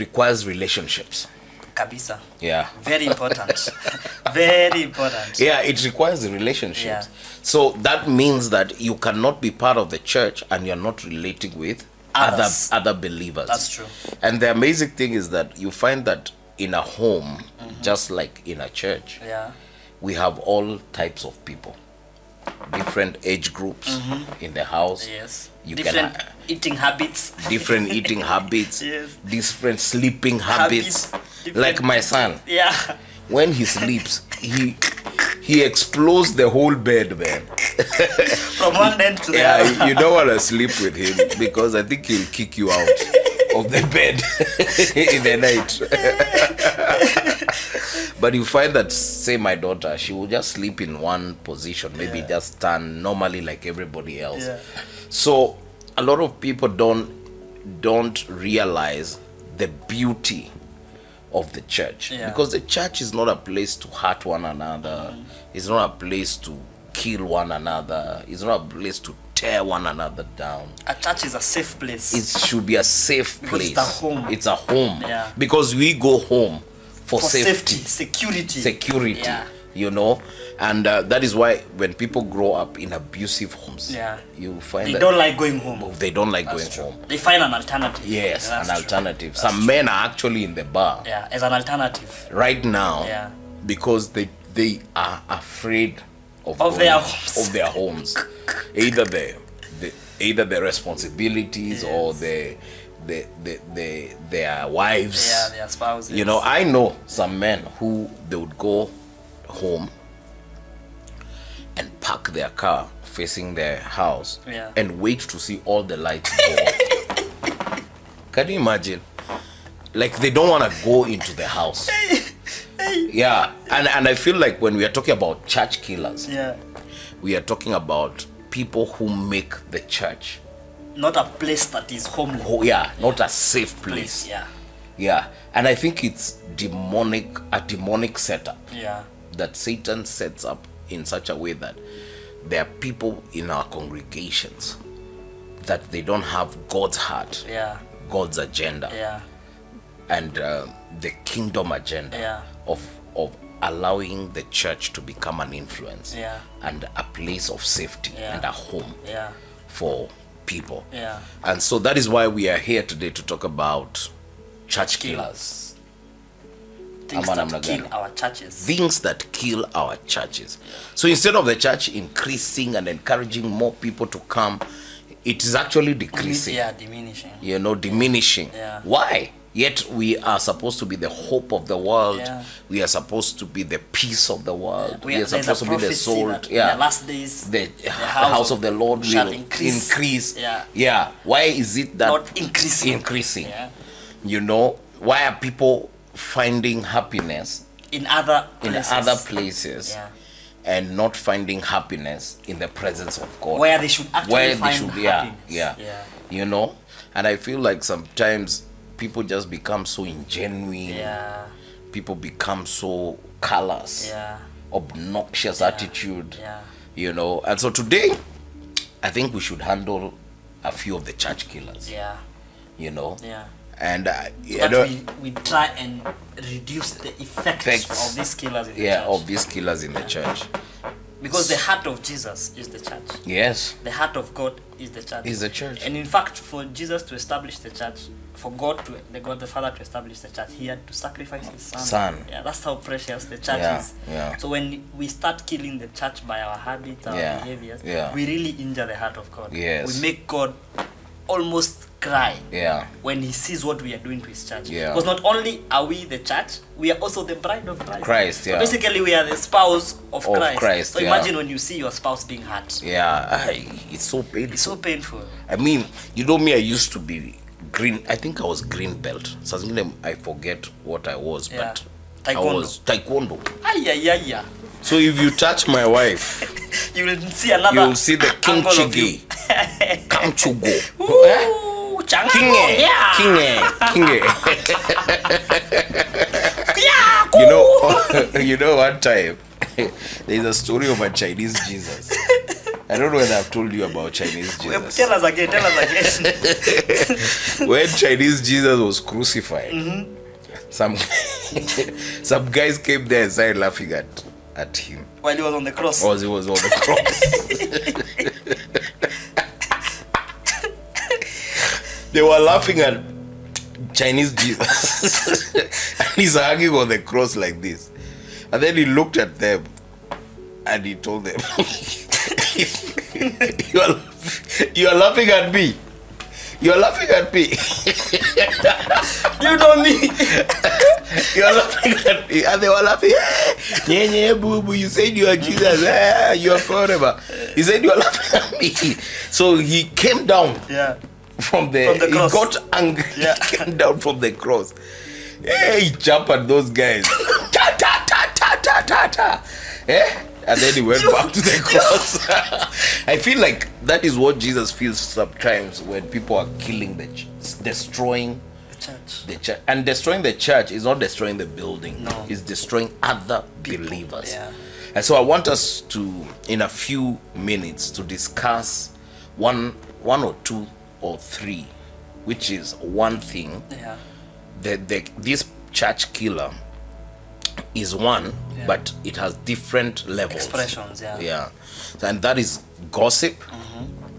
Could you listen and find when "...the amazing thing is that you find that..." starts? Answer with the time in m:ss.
0:14.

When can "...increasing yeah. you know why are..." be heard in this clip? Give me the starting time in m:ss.
3:12.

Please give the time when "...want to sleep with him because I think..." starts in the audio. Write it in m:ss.
0:40.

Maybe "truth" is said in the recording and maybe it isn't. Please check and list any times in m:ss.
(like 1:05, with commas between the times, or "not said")
not said.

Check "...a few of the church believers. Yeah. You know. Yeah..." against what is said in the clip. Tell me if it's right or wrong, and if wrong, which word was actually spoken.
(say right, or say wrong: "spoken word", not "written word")
wrong: "killers", not "believers".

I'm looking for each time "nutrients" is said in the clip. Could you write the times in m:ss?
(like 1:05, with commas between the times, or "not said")
not said.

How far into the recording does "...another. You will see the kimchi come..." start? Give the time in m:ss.
4:37.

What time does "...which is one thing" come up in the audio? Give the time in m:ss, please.
6:12.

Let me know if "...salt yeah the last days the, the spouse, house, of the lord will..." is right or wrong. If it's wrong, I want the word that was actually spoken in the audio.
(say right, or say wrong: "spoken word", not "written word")
wrong: "house", not "spouse".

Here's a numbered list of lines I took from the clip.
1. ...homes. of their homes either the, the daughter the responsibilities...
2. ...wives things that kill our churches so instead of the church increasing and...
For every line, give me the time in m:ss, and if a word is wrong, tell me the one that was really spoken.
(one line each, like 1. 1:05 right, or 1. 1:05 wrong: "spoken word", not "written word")
1. 1:36 wrong: "either", not "daughter"
2. 2:48 wrong: "churches", not "wives".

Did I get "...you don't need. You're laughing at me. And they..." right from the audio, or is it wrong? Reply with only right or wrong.
right.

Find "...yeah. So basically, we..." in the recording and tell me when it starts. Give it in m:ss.
4:18.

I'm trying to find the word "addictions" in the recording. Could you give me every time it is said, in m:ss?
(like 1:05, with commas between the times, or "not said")
not said.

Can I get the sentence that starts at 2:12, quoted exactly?
Oh, yeah, not a safe place.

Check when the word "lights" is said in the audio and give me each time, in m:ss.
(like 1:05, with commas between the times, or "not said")
1:55.